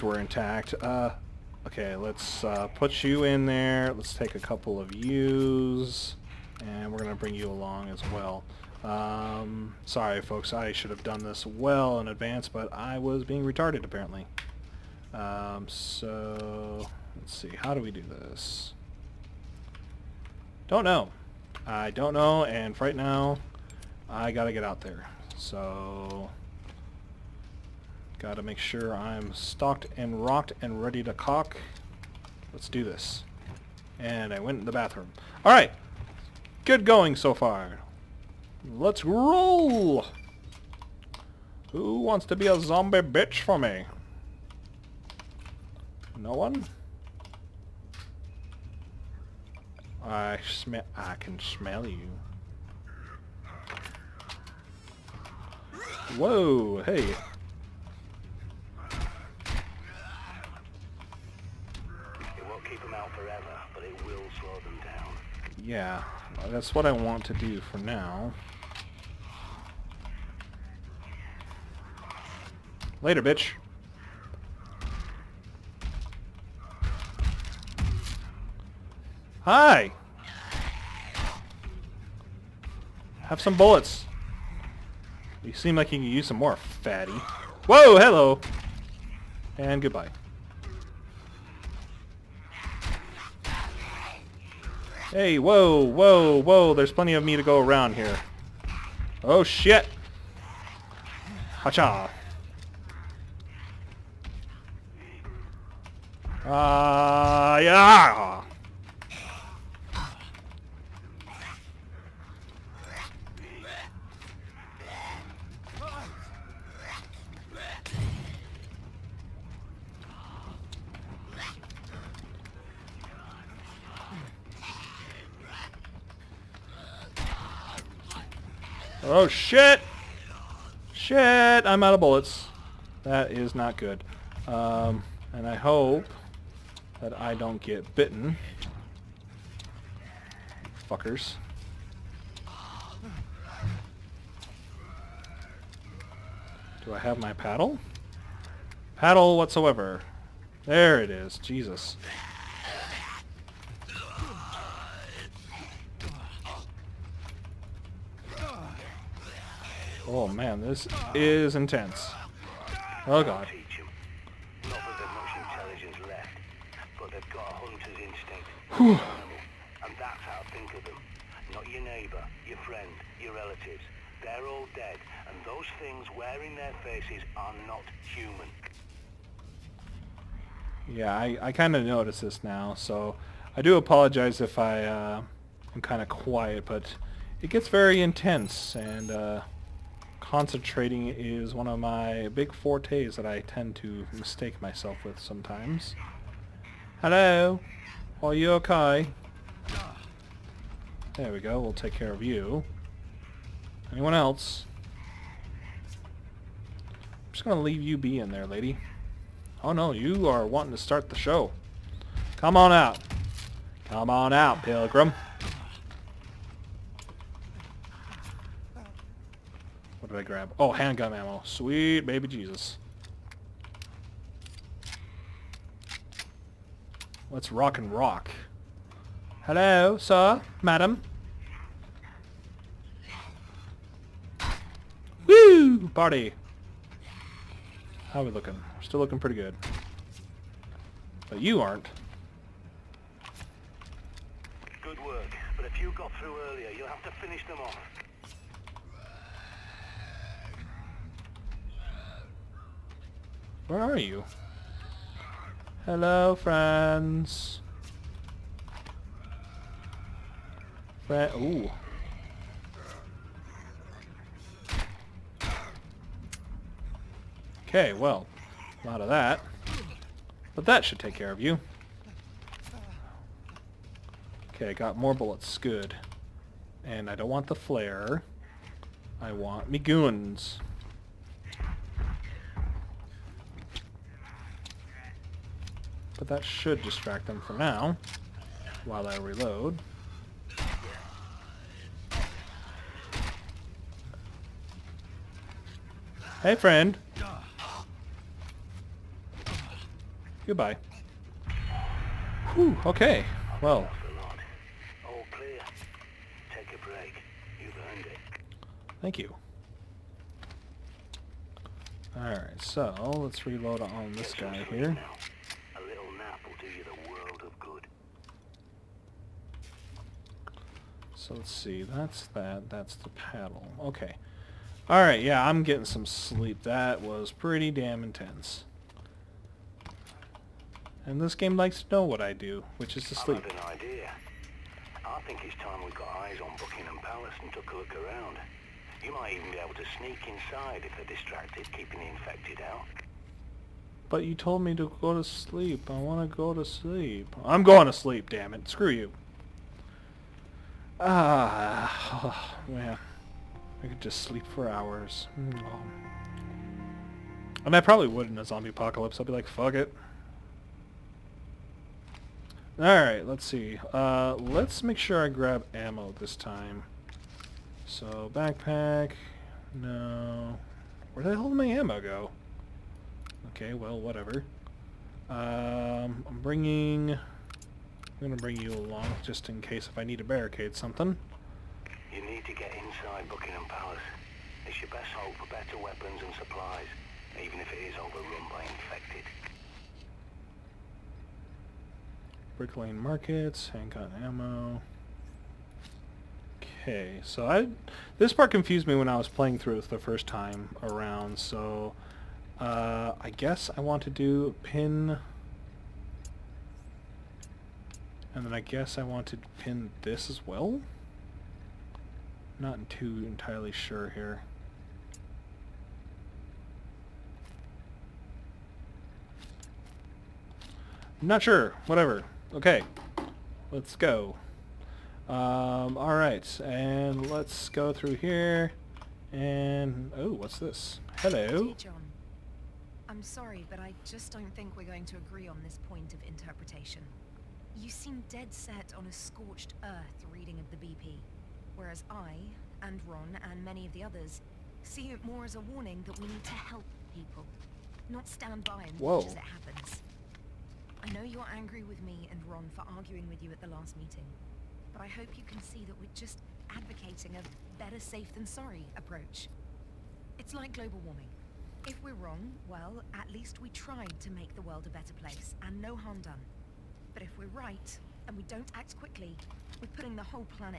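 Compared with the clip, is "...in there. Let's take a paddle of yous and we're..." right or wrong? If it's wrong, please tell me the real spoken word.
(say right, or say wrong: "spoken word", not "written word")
wrong: "couple", not "paddle".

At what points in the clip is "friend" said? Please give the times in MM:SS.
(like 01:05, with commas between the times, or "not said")
02:52, 04:16, 04:56.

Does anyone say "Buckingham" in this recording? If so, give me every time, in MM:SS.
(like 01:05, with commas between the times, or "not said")
05:36, 06:23.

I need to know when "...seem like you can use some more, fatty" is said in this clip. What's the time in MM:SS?
01:25.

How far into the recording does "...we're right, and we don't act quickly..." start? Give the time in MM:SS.
07:47.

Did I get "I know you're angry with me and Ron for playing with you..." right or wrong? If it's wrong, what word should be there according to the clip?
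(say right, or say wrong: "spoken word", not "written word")
wrong: "arguing", not "playing".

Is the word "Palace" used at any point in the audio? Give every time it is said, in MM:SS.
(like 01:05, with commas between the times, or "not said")
05:37, 06:23.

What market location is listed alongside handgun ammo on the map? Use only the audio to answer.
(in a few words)
Brick Lane Markets.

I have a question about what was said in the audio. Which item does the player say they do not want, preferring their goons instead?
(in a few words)
The flare.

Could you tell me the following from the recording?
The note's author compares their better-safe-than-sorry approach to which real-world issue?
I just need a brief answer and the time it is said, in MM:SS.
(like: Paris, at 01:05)
Global warming, at 07:40.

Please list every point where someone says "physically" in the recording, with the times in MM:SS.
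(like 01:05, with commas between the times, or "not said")
not said.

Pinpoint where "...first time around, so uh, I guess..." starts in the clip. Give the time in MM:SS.
06:39.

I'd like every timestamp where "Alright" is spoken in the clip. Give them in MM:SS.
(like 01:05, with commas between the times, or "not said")
00:35, 05:12, 05:24, 06:02, 07:05.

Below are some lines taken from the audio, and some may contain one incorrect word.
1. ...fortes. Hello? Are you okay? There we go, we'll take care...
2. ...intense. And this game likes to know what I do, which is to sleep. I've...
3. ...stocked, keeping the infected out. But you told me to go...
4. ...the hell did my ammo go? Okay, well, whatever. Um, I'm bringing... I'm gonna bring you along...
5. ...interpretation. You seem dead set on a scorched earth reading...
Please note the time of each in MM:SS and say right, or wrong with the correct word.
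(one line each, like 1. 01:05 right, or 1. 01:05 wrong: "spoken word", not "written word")
1. 03:15 wrong: "sometimes", not "fortes"
2. 05:28 right
3. 05:41 wrong: "distracted", not "stocked"
4. 06:11 right
5. 07:16 right.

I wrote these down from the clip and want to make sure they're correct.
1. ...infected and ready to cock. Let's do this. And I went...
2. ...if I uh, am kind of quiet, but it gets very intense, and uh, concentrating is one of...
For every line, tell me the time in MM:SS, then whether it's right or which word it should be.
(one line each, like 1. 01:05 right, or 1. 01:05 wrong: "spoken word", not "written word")
1. 00:30 wrong: "rocked", not "infected"
2. 03:04 right.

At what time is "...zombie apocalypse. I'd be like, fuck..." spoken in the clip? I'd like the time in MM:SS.
05:58.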